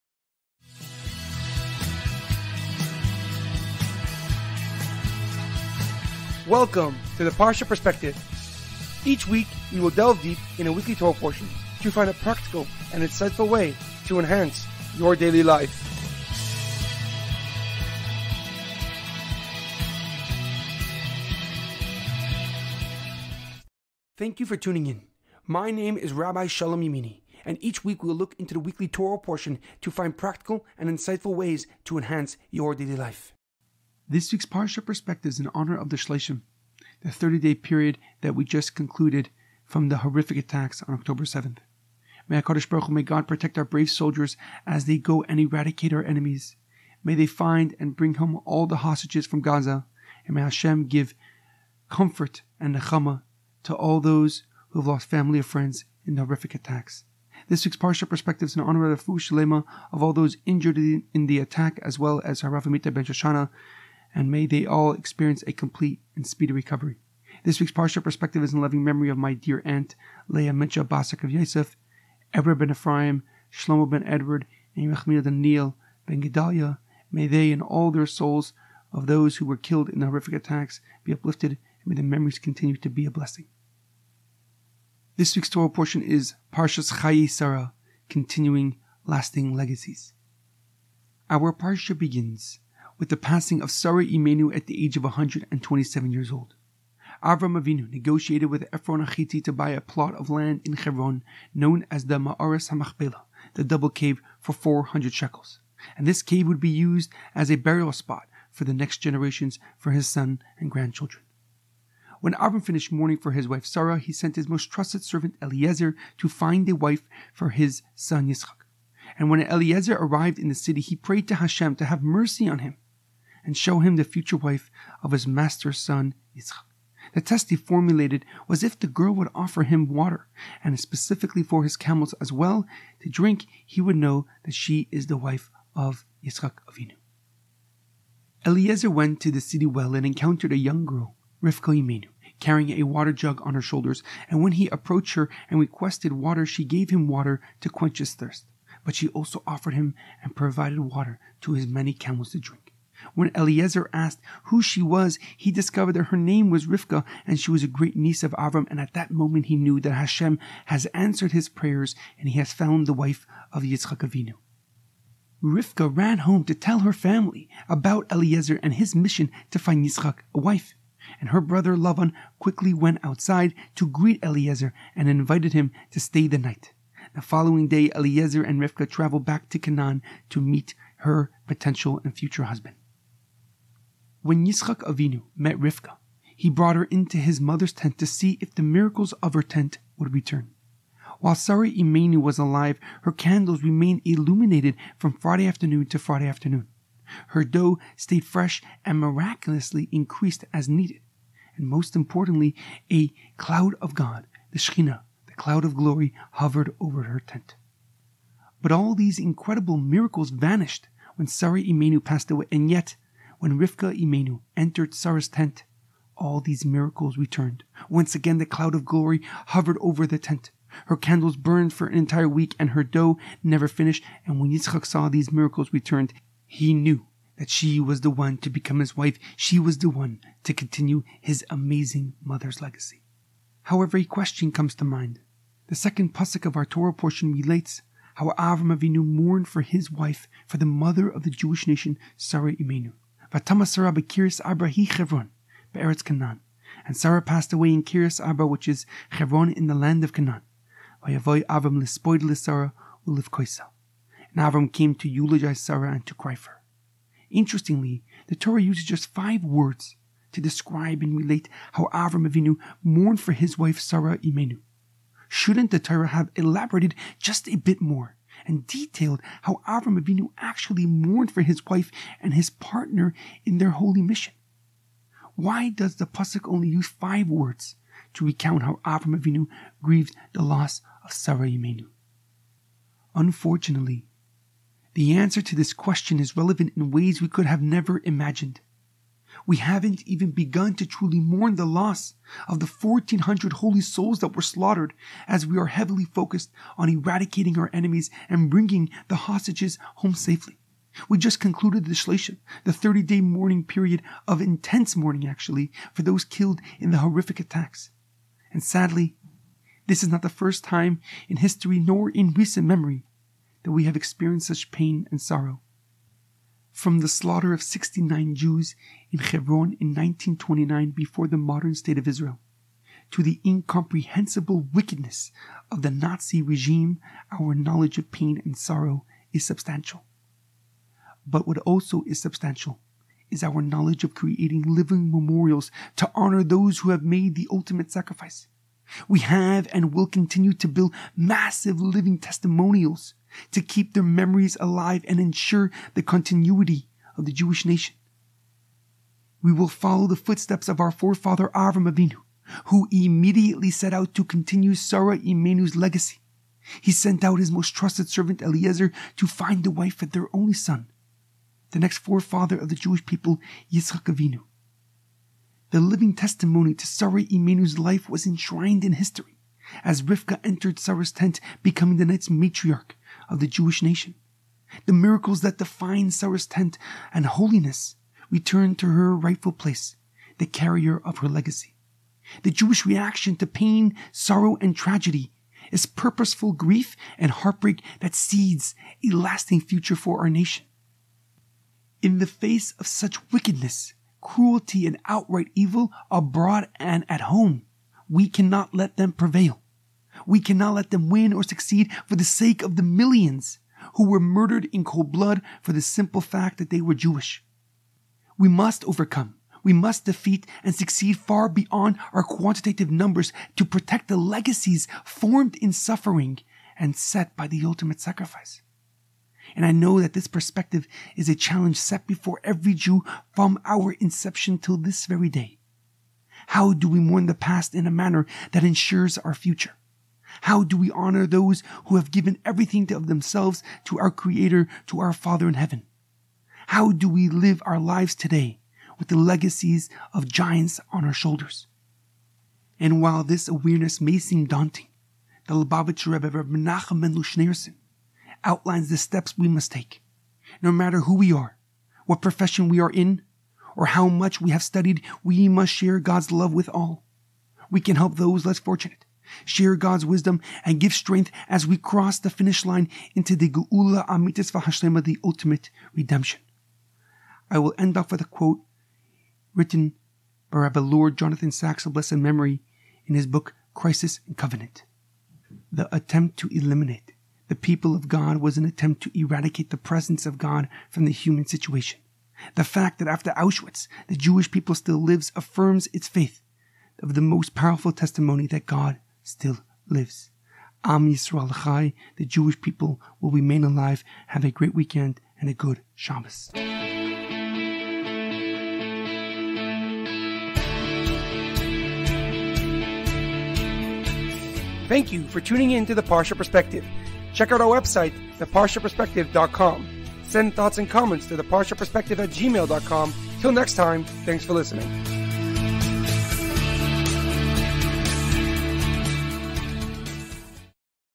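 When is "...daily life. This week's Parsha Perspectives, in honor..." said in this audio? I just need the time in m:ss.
0:32.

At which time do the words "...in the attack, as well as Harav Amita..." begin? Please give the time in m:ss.
1:00.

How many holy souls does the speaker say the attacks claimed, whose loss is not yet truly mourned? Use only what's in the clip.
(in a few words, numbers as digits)
1,400.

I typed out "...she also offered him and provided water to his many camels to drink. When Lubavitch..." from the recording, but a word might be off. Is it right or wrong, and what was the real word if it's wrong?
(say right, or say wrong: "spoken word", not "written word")
wrong: "Eliezer", not "Lubavitch".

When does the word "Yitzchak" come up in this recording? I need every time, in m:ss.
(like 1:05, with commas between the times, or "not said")
1:58, 2:06, 2:16, 2:43, 2:49, 3:04, 3:44, 6:03.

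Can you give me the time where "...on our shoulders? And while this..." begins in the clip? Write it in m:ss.
7:20.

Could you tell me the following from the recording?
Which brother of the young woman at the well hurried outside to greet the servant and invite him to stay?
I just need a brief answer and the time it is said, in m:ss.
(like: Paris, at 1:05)
Lavan, at 2:51.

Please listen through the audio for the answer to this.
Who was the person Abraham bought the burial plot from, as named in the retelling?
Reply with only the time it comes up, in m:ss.
1:38.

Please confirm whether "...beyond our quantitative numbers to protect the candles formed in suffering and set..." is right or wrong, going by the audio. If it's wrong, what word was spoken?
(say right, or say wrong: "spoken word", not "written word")
wrong: "legacies", not "candles".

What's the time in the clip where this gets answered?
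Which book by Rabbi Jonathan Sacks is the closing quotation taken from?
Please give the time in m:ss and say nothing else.
7:53.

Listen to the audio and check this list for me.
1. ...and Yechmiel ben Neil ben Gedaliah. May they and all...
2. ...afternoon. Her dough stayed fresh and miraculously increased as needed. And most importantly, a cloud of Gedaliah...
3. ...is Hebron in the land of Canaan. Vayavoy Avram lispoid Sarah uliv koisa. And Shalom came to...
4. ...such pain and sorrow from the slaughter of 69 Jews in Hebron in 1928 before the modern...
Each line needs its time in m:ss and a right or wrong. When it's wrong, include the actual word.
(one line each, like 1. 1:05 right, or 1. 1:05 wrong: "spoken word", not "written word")
1. 1:14 right
2. 3:16 wrong: "God", not "Gedaliah"
3. 4:08 wrong: "Avram", not "Shalom"
4. 5:14 wrong: "1929", not "1928".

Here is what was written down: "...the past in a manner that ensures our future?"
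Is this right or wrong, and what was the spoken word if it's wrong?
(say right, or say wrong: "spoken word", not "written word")
right.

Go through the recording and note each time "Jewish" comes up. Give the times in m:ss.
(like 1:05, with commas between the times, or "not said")
4:01, 5:47, 6:02, 6:13, 6:22, 6:46, 8:04, 8:12.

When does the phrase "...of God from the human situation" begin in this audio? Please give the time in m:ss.
8:00.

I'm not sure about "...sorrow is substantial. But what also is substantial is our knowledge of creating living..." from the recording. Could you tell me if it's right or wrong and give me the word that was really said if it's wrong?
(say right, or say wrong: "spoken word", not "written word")
right.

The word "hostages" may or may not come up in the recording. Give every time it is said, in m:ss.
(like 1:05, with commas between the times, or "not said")
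0:48, 4:59.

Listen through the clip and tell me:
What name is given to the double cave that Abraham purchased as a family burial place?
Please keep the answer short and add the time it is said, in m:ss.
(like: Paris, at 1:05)
Mearas HaMachpelah, at 1:42.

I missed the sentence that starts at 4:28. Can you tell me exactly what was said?
and detailed how Avram Avinu actually mourned for his wife and his partner in their holy mission.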